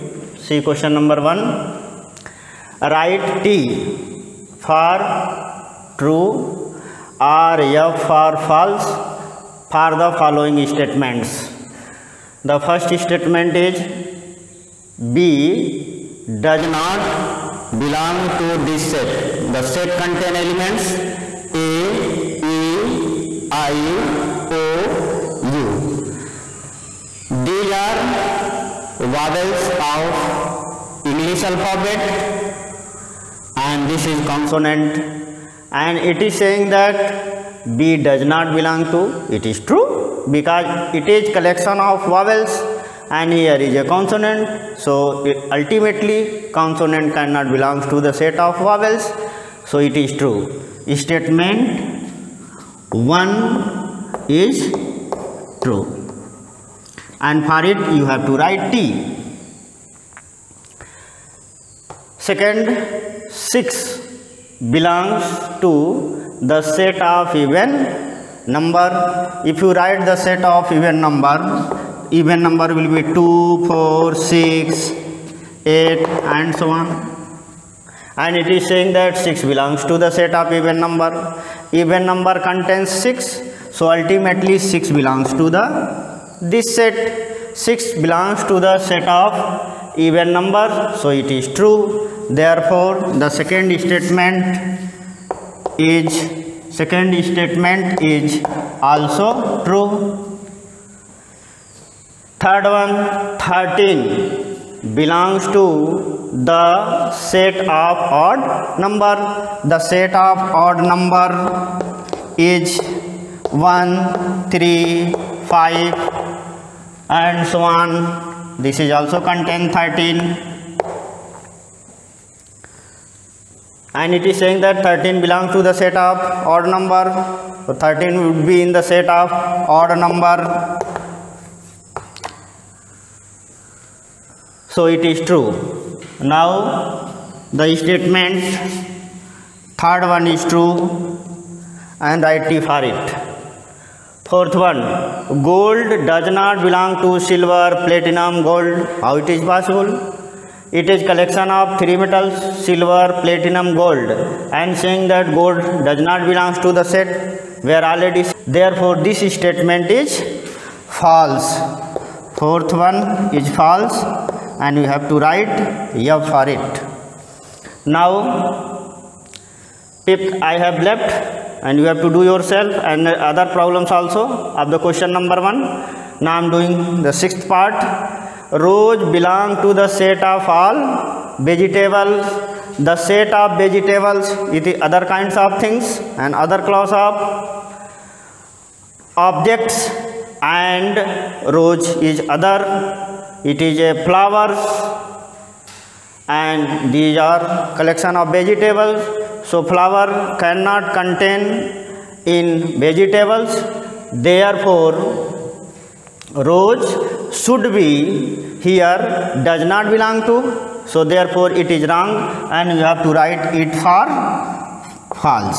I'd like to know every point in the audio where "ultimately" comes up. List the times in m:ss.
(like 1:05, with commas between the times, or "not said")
0:45, 1:23.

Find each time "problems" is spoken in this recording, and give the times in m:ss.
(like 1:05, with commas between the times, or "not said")
2:53.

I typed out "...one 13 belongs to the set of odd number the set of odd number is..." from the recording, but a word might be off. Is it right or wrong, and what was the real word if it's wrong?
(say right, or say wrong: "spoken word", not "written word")
right.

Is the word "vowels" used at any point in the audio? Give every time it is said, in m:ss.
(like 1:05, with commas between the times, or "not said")
0:29, 0:42, 0:48.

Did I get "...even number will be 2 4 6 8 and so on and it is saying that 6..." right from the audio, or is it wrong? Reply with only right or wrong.
right.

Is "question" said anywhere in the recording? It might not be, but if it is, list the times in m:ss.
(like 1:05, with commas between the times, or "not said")
0:00, 2:54.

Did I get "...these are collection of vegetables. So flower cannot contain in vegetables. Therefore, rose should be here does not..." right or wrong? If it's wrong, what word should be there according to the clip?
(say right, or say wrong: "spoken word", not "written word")
right.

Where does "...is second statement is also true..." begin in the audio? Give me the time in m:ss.
1:35.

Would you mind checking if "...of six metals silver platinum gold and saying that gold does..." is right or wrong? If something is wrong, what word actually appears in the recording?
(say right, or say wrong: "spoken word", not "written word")
wrong: "three", not "six".